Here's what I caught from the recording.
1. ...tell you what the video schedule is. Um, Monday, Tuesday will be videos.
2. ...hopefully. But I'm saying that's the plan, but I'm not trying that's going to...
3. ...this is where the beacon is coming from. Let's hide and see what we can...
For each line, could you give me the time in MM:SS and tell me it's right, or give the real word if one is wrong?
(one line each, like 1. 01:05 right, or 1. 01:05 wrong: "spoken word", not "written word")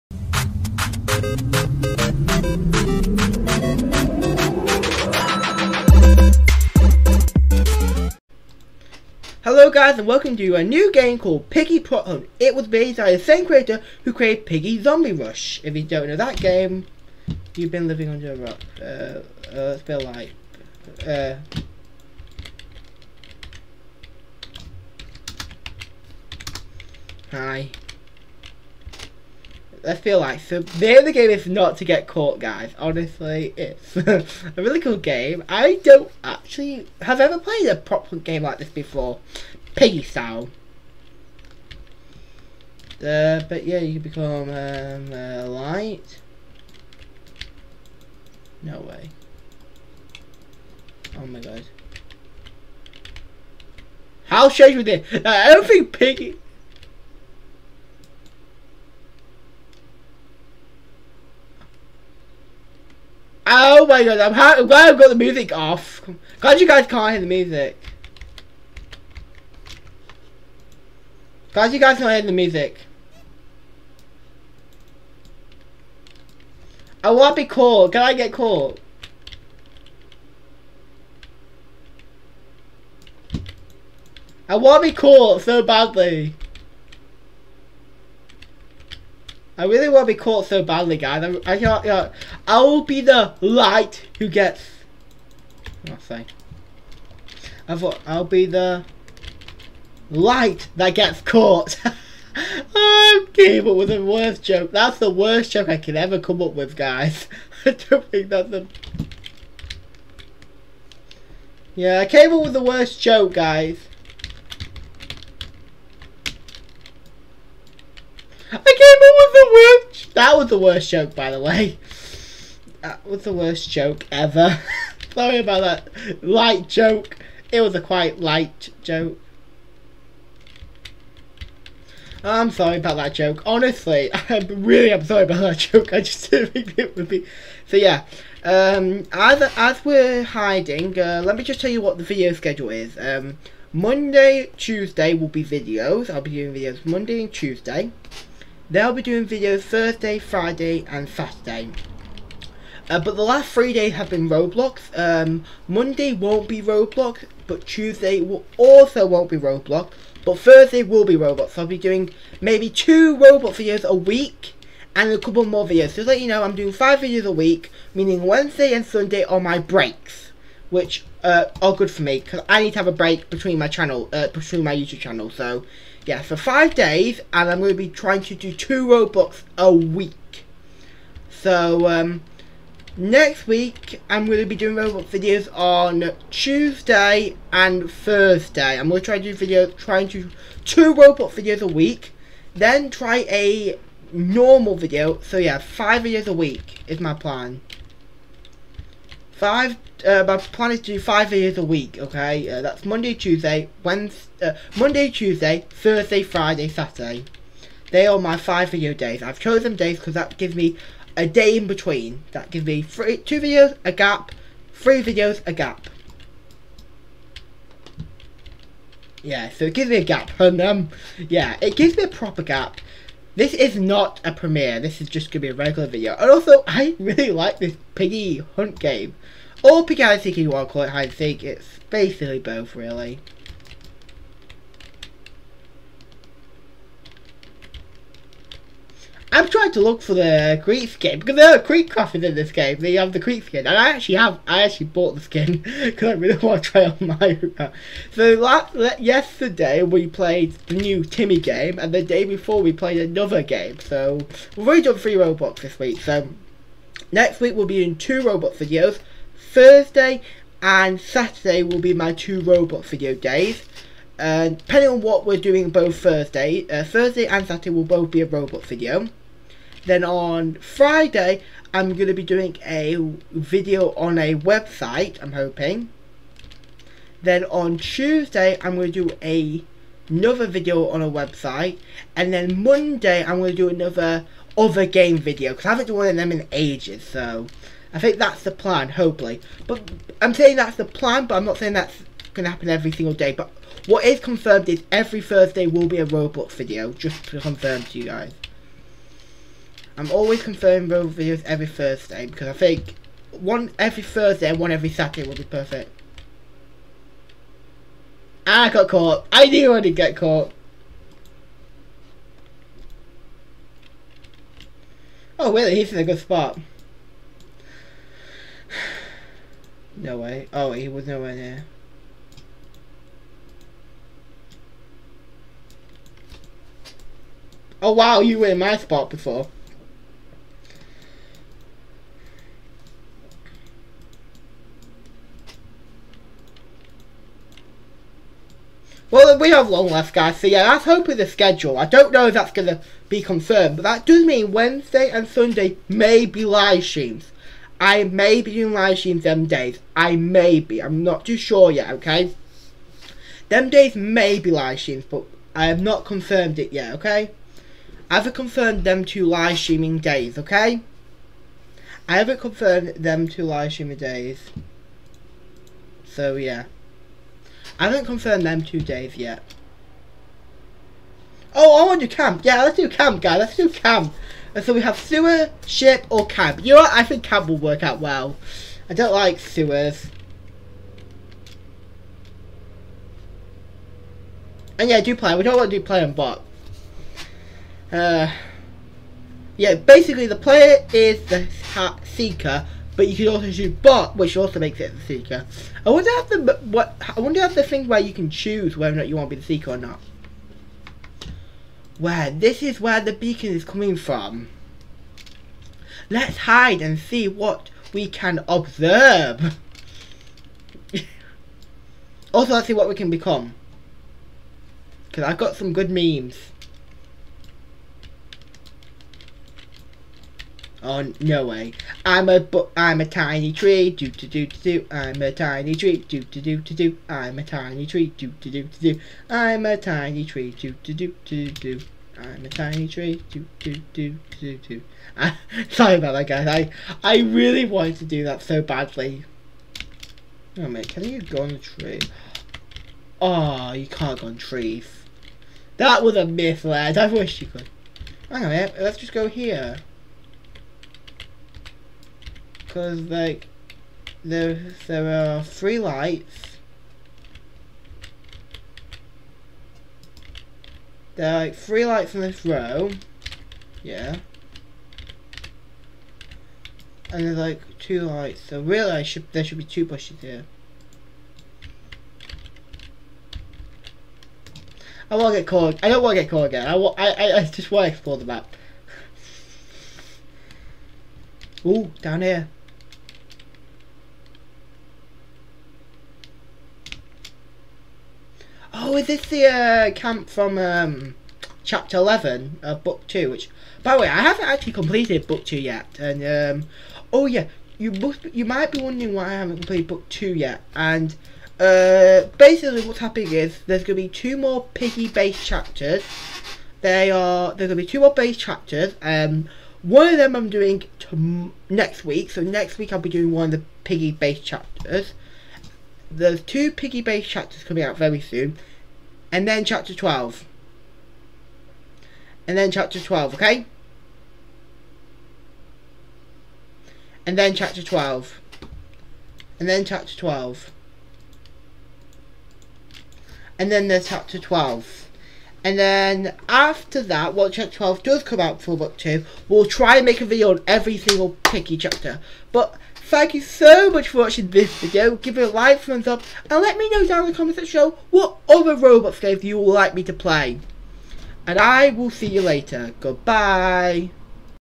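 1. 02:21 right
2. 04:48 wrong: "saying", not "trying"
3. 06:42 right.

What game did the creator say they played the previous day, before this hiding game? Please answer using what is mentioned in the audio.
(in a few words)
the new Timmy game.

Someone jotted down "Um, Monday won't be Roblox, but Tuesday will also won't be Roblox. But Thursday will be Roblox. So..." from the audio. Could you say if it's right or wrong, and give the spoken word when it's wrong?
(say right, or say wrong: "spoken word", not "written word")
right.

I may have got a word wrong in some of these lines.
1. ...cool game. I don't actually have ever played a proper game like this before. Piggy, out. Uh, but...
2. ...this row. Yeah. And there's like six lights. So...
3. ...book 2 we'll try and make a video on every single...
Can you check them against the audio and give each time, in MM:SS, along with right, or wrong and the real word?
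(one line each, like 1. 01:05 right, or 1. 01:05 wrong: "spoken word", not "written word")
1. 00:34 right
2. 07:42 wrong: "two", not "six"
3. 08:58 right.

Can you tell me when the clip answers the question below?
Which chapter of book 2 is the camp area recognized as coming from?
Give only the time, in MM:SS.
08:11.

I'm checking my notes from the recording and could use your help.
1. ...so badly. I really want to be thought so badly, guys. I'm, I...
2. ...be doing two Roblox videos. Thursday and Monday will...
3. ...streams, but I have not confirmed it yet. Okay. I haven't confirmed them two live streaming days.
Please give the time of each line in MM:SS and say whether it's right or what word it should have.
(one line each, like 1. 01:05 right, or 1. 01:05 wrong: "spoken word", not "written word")
1. 01:25 wrong: "caught", not "thought"
2. 04:17 wrong: "Saturday", not "Monday"
3. 05:54 right.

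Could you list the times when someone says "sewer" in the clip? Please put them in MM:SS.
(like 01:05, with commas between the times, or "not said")
06:14, 06:19.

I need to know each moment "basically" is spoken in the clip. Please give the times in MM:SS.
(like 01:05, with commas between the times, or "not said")
03:51, 06:29, 08:22.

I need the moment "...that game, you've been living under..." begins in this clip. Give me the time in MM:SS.
00:16.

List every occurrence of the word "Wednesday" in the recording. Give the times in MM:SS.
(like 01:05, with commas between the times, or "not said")
02:48, 03:23, 05:44.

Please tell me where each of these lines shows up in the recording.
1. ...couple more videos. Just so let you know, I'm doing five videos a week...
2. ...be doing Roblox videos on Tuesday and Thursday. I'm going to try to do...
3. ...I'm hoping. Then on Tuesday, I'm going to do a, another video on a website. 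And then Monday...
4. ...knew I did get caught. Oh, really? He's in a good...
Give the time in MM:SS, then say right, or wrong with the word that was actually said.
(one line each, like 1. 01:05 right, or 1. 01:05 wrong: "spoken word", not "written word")
1. 02:45 right
2. 03:04 right
3. 04:35 right
4. 05:09 right.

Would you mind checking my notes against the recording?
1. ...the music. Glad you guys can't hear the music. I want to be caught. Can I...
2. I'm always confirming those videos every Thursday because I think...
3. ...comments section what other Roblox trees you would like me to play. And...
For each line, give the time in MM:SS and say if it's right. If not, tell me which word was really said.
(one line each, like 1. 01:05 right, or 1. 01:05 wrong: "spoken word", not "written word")
1. 01:07 right
2. 04:59 right
3. 09:07 wrong: "games", not "trees".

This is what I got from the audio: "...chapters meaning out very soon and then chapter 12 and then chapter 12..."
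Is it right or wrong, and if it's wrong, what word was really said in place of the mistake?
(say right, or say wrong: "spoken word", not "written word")
wrong: "coming", not "meaning".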